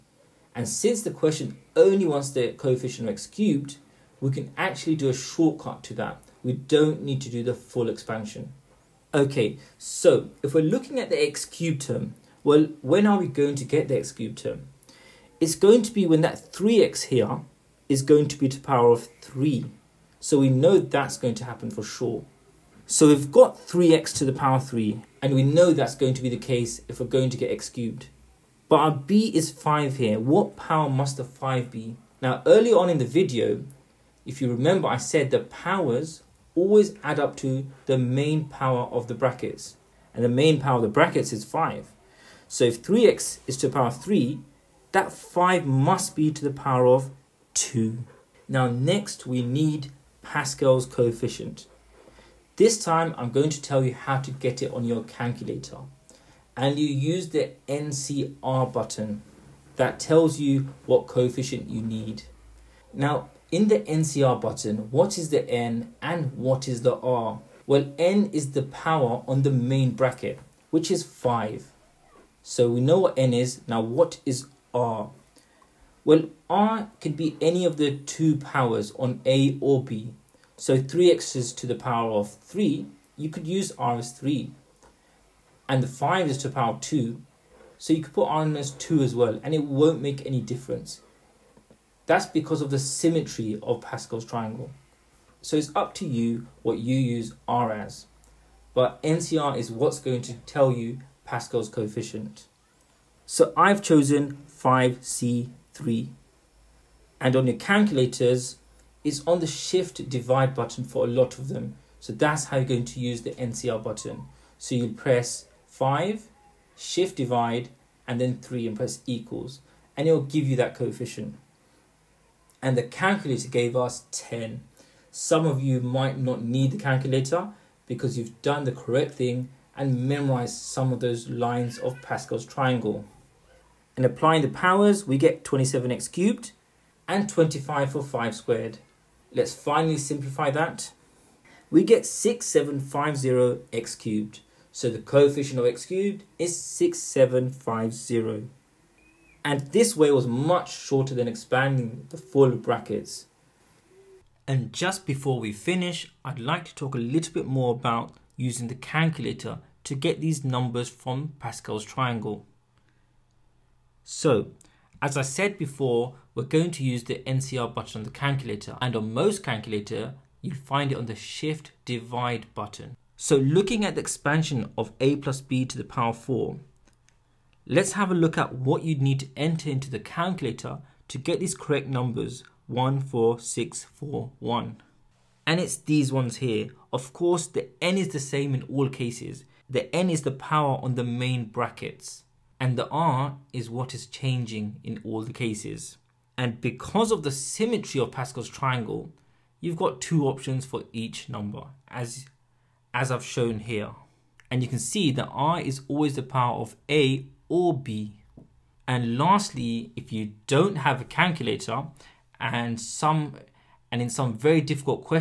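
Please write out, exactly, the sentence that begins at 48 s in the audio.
Now next we need Pascal's coefficient.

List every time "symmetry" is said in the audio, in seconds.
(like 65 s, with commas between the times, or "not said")
92 s, 197 s.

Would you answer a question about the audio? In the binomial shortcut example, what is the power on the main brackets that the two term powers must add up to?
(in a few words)
5.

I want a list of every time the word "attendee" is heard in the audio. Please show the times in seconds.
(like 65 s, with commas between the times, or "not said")
not said.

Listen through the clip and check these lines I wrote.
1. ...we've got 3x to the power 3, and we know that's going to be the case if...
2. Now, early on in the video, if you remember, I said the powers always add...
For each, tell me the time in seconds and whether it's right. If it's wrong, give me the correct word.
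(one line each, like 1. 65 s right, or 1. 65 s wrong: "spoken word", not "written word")
1. 23 s right
2. 32 s right.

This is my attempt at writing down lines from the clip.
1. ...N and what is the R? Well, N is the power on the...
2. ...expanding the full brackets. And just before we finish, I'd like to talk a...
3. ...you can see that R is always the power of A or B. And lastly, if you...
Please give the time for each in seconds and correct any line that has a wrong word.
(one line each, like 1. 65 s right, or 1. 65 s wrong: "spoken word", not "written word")
1. 65 s right
2. 151 s right
3. 204 s right.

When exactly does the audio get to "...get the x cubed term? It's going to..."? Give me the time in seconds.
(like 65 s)
13 s.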